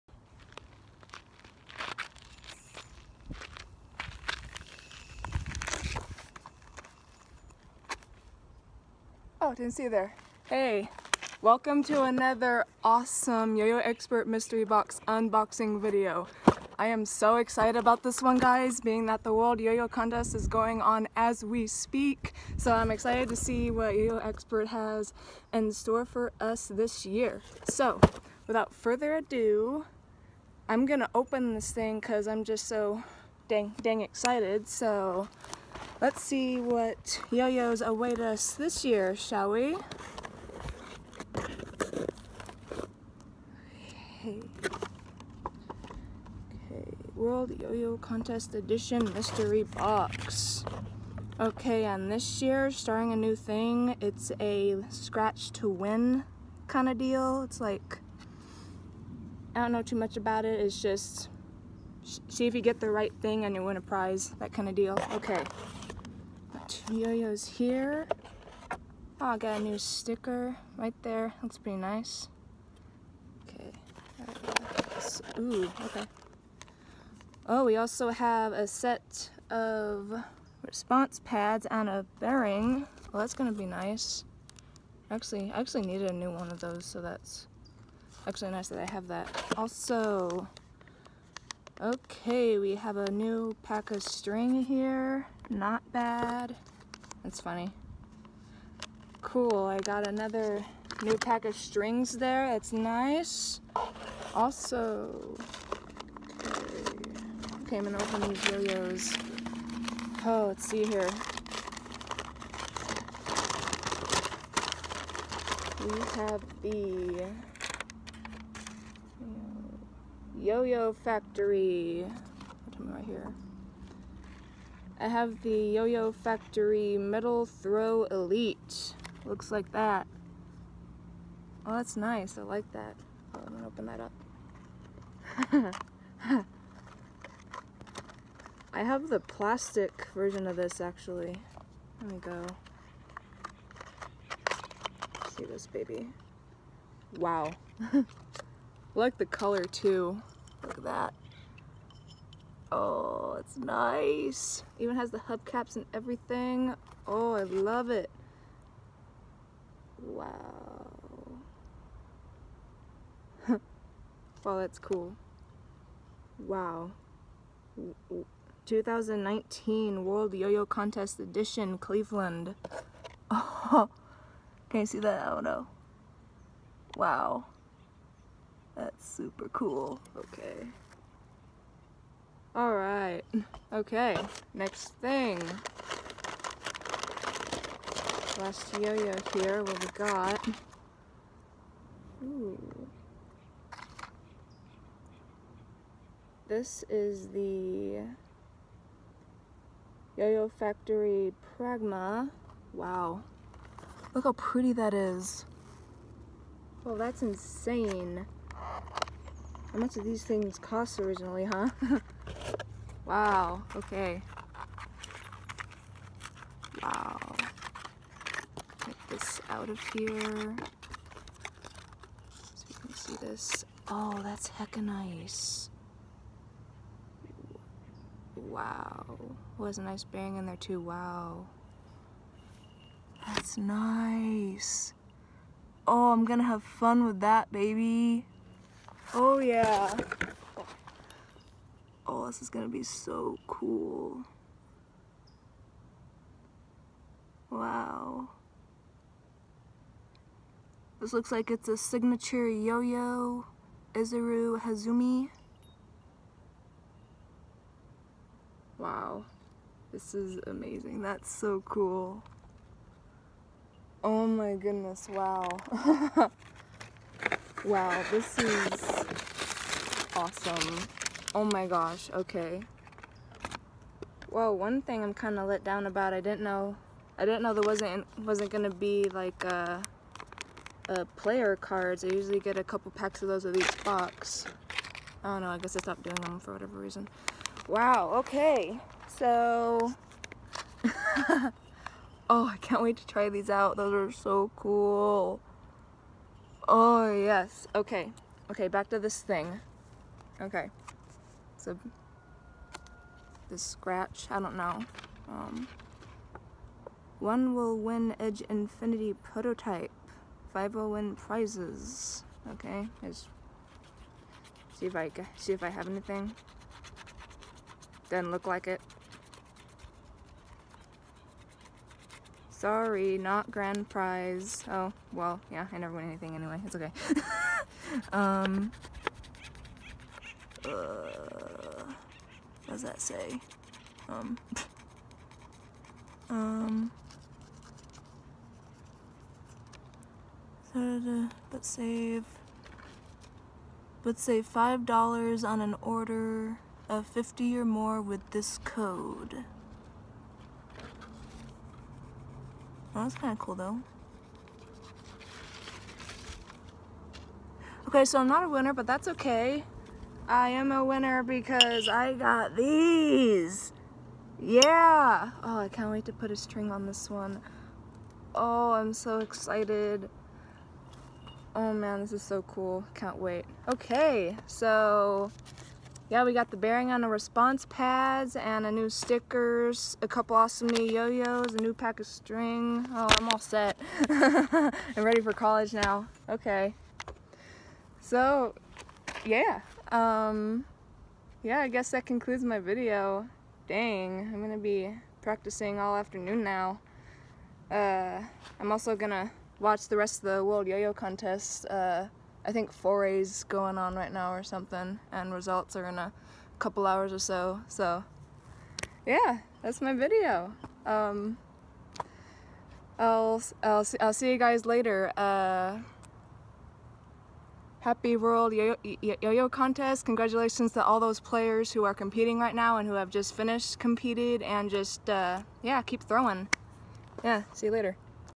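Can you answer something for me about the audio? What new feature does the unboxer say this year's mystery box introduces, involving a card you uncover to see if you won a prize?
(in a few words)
scratch to win.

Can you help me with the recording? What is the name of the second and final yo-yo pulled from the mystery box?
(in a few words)
Pragma.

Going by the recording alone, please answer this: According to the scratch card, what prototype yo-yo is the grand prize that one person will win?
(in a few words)
Edge Infinity.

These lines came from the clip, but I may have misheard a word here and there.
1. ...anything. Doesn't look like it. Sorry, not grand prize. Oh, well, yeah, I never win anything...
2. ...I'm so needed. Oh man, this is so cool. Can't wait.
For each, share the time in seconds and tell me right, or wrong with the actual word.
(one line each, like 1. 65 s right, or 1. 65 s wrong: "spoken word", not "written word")
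1. 315 s right
2. 368 s wrong: "excited", not "needed".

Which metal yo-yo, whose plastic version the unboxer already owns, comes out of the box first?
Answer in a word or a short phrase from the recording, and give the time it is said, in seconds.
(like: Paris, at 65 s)
Metal Throw Elite, at 126 s.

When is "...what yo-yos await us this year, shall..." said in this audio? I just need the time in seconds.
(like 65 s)
36 s.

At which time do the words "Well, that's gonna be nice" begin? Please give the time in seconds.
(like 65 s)
83 s.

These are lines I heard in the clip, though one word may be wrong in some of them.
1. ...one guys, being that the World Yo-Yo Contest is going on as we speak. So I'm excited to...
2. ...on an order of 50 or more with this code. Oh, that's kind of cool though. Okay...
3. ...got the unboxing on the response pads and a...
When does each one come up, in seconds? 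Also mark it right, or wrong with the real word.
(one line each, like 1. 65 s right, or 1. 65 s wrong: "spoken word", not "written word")
1. 18 s right
2. 345 s right
3. 376 s wrong: "bearing", not "unboxing".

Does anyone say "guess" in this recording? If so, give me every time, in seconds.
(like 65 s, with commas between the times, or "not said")
285 s, 391 s.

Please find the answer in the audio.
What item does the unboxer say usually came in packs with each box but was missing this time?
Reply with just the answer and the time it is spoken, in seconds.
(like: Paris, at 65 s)
player cards, at 281 s.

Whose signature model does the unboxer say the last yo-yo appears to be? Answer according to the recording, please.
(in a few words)
Izuru Hazumi.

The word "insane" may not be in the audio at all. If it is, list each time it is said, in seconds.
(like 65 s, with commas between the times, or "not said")
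207 s.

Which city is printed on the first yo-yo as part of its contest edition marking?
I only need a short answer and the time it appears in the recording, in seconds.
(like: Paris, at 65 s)
Cleveland, at 171 s.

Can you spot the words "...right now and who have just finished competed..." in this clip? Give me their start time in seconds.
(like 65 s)
422 s.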